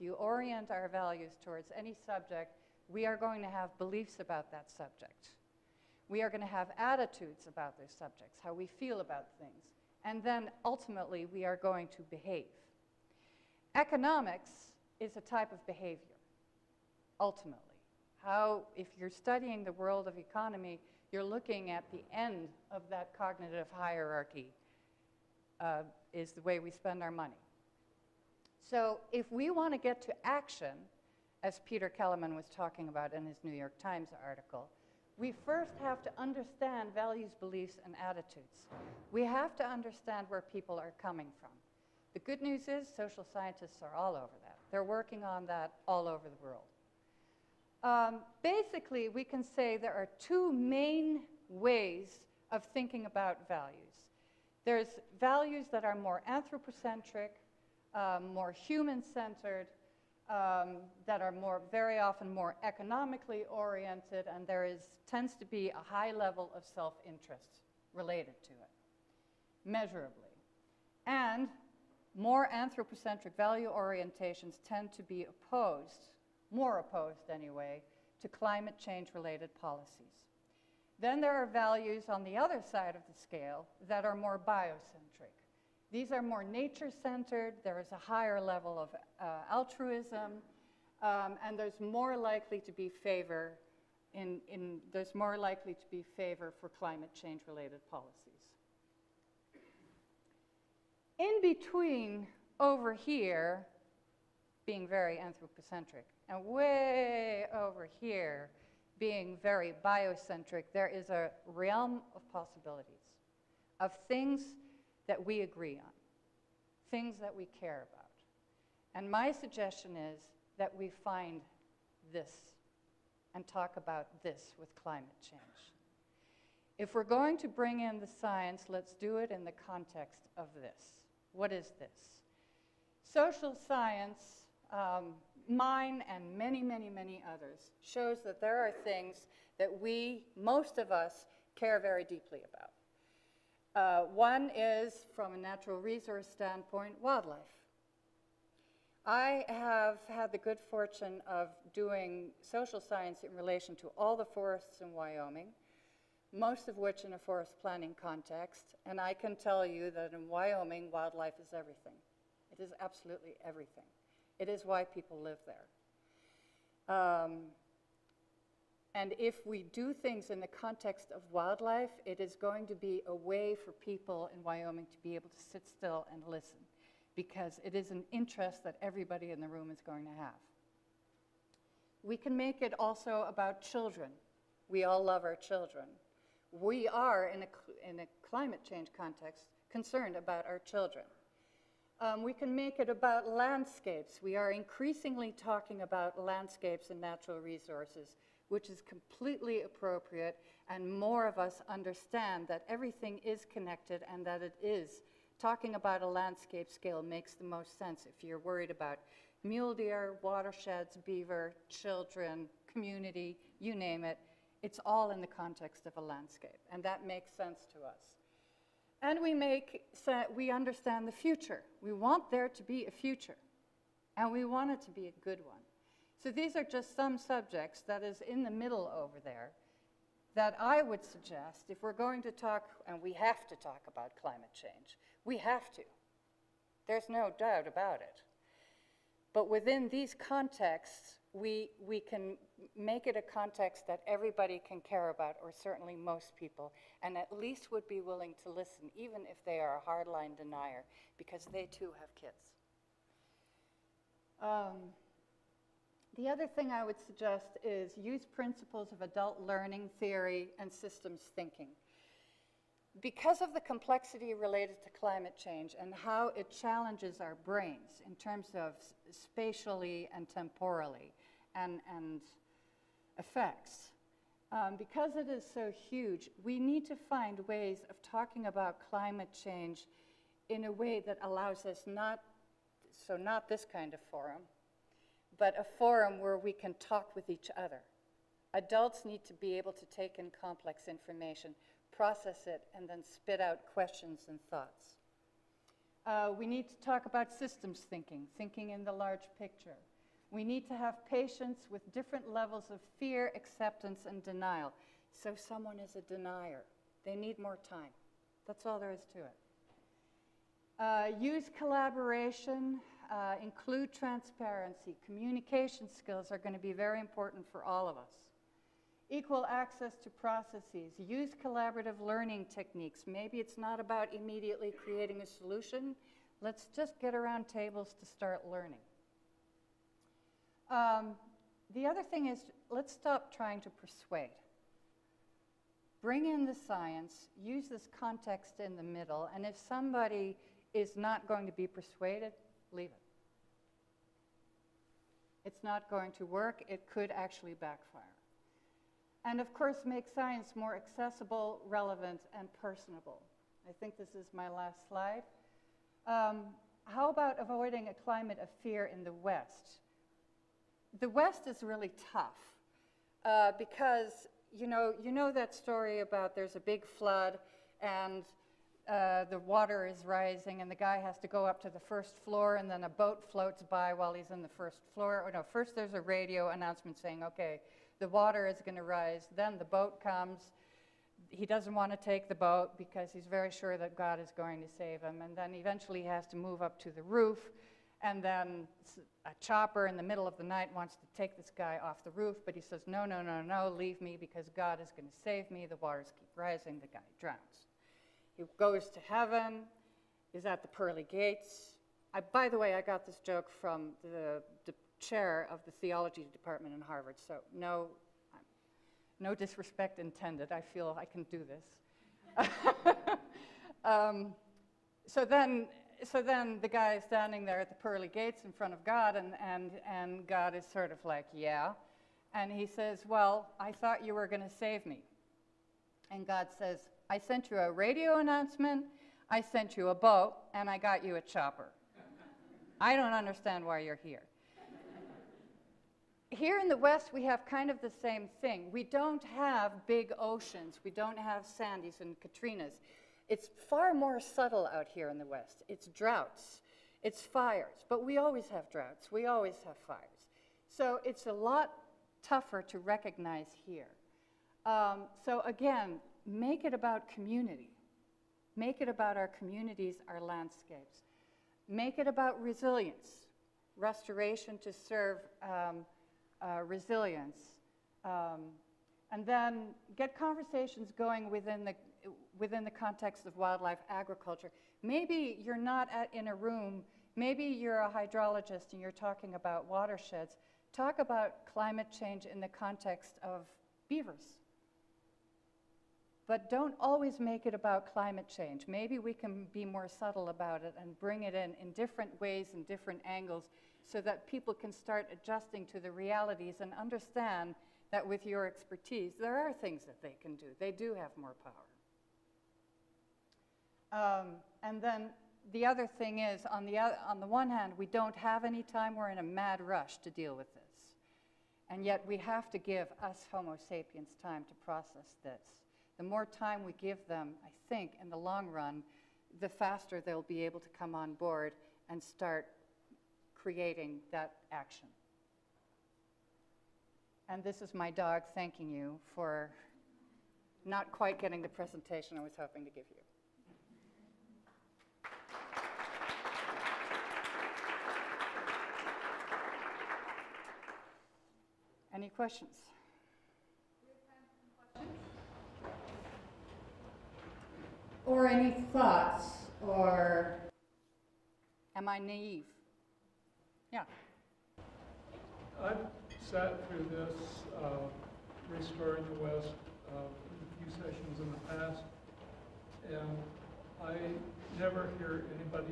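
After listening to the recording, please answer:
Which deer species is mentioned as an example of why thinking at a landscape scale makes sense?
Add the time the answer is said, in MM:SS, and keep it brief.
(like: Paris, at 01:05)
mule deer, at 03:29.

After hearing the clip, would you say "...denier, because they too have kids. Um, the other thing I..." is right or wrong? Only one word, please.
right.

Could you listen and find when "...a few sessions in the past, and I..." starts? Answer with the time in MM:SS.
09:19.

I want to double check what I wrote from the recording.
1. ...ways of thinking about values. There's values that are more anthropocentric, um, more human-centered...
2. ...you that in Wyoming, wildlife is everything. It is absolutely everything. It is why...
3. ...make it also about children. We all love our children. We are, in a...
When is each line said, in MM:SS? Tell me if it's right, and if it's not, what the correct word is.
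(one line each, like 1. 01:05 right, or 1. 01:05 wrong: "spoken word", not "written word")
1. 00:51 right
2. 02:39 right
3. 03:02 right.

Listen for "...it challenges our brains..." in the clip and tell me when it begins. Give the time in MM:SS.
04:26.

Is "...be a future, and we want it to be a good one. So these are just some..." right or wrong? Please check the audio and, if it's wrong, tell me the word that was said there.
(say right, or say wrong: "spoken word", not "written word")
right.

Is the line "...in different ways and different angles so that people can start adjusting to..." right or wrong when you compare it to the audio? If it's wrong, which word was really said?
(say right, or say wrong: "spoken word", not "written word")
right.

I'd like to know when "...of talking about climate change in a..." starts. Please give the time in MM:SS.
04:37.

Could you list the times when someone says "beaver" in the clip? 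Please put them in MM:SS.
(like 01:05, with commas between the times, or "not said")
03:31, 08:03.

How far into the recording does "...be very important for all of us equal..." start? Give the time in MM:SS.
05:16.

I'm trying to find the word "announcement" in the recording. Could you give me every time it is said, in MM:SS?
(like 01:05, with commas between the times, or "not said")
06:16, 07:08.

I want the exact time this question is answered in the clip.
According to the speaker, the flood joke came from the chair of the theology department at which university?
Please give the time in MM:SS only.
06:46.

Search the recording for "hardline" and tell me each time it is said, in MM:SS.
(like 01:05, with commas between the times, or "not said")
04:09.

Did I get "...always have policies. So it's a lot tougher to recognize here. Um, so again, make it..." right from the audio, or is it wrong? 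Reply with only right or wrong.
wrong.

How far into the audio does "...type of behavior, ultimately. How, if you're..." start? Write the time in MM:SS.
00:15.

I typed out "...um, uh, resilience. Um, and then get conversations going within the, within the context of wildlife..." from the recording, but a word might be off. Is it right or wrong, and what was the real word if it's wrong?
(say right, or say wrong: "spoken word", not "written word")
right.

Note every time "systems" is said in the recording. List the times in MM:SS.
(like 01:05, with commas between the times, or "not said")
04:20, 04:57.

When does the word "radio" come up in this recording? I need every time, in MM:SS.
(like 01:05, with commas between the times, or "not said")
06:16, 07:07.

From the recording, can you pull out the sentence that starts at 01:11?
And more anthropocentric value orientations tend to be opposed, more opposed anyway, to climate change-related policies.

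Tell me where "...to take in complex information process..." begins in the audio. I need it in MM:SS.
04:49.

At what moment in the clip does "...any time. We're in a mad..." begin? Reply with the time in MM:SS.
08:28.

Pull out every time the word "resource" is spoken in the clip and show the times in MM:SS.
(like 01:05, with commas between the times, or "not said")
02:25, 03:17.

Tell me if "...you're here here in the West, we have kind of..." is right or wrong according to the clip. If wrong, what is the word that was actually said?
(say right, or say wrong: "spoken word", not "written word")
right.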